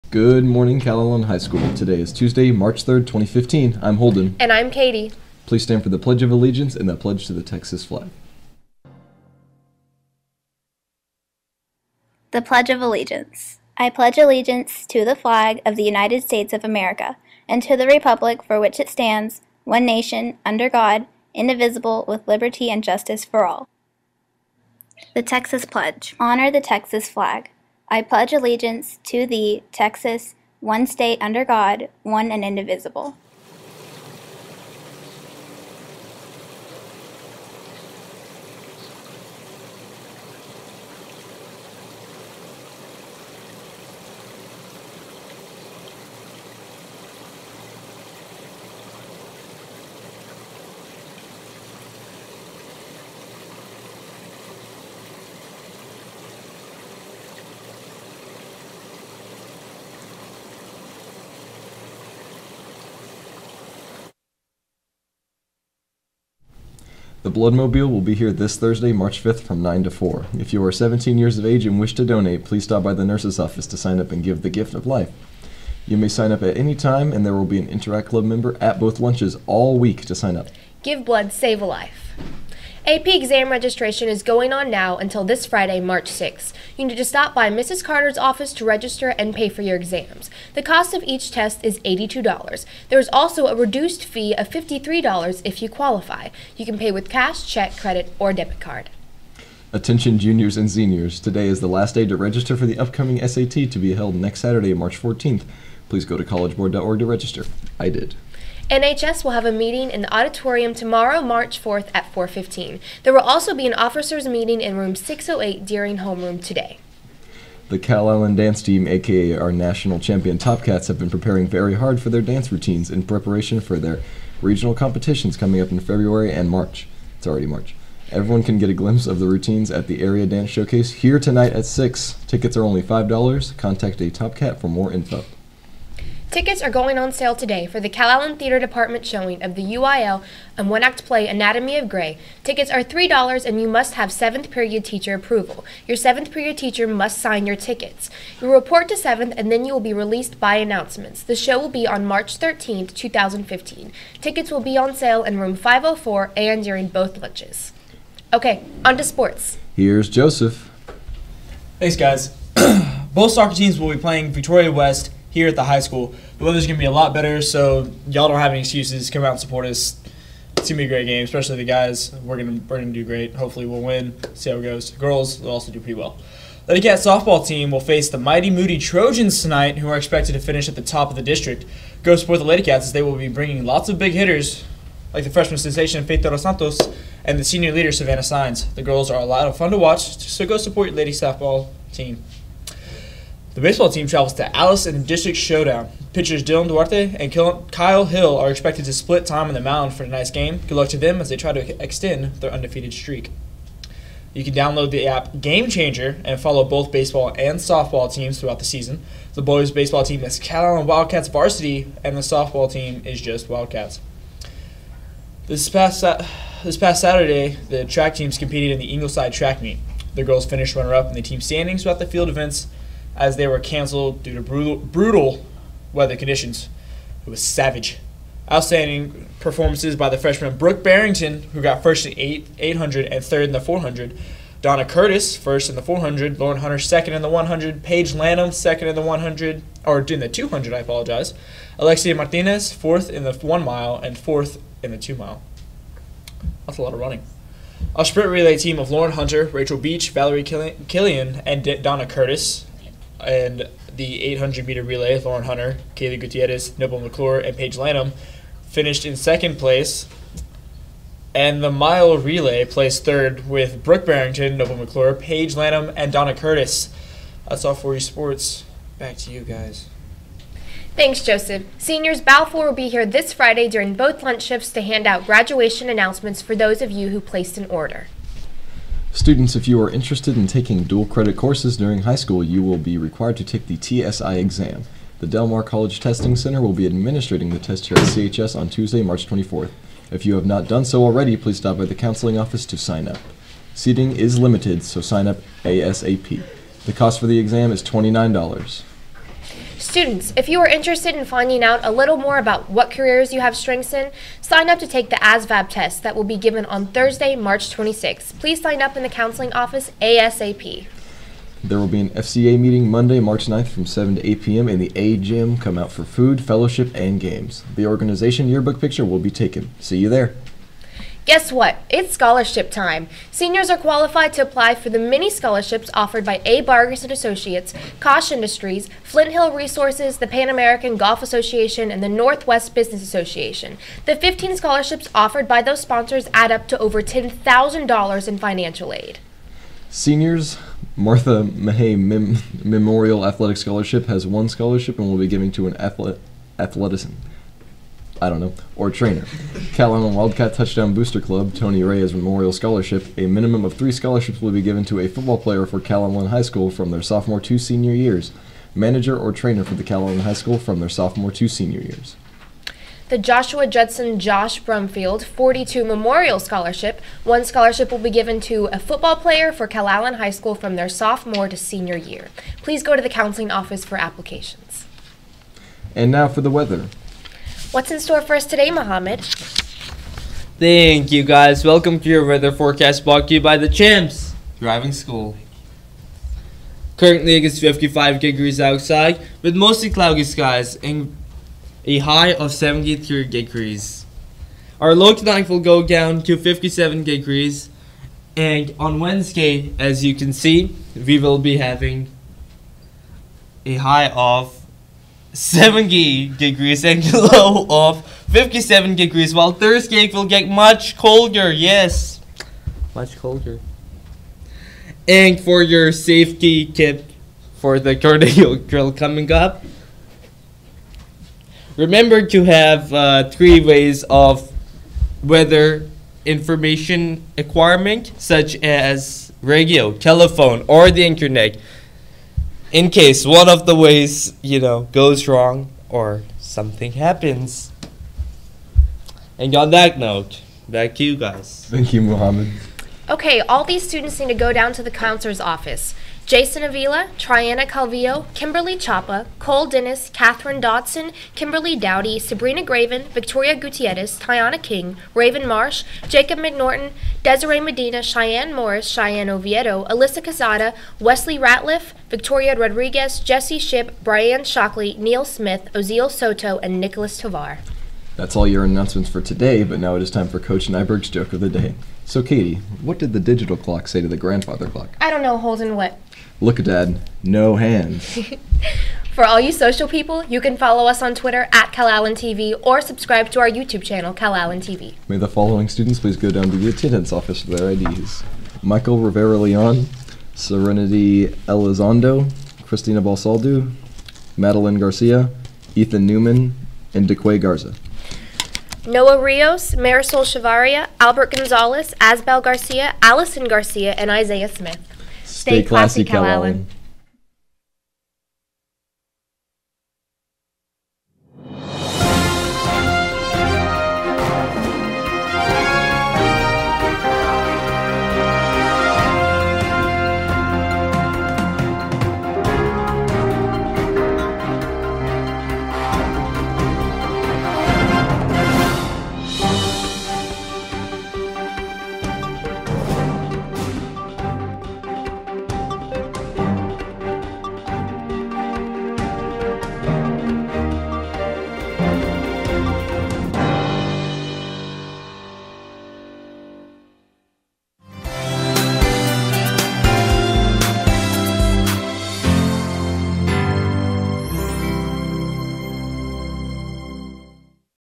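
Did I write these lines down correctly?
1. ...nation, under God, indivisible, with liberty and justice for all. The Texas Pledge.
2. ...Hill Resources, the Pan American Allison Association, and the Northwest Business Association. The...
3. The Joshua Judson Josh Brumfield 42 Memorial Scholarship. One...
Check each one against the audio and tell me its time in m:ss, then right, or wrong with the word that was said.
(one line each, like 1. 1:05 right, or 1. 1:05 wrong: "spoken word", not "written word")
1. 0:19 right
2. 5:29 wrong: "Golf", not "Allison"
3. 6:03 right.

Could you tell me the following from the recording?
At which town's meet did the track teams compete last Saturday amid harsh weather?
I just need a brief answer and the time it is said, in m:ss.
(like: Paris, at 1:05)
Ingleside, at 3:38.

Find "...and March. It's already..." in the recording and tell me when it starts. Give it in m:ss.
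2:06.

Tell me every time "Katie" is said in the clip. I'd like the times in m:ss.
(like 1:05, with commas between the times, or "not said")
0:04, 7:52.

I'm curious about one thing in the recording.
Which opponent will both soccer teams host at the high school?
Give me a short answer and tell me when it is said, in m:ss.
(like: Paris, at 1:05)
Victoria West, at 2:44.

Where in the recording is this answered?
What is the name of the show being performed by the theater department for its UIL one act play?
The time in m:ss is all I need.
2:21.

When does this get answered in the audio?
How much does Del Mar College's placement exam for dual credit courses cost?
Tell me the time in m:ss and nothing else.
4:57.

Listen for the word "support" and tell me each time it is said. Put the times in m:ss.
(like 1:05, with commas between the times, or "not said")
2:49, 3:02, 3:10.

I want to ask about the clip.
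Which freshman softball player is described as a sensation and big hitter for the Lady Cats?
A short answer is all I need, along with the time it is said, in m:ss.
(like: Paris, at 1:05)
Faith Dos Santos, at 3:06.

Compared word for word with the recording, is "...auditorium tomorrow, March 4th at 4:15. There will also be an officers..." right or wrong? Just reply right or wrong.
right.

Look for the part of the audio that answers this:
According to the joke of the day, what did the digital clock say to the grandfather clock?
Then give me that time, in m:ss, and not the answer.
7:56.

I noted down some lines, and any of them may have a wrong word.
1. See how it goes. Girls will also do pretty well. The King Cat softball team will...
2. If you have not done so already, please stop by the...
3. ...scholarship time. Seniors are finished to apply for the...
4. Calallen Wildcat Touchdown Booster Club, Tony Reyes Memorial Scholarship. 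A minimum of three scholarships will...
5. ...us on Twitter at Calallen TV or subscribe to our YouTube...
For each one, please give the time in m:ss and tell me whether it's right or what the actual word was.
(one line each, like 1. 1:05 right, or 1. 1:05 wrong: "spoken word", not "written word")
1. 2:54 wrong: "Lady", not "King"
2. 4:50 right
3. 5:22 wrong: "qualified", not "finished"
4. 5:49 right
5. 8:00 right.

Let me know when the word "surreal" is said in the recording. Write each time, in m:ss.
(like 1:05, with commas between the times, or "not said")
not said.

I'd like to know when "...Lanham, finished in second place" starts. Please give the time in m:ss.
4:17.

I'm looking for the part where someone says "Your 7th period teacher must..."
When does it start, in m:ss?
2:25.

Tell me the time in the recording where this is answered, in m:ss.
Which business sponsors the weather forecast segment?
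6:23.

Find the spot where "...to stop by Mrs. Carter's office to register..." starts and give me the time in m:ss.
1:26.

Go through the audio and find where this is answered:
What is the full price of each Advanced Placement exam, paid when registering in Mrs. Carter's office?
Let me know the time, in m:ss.
1:31.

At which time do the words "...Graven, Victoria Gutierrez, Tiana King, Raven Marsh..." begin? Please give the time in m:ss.
7:32.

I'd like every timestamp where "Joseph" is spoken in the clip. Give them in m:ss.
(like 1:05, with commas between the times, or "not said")
2:40, 4:31.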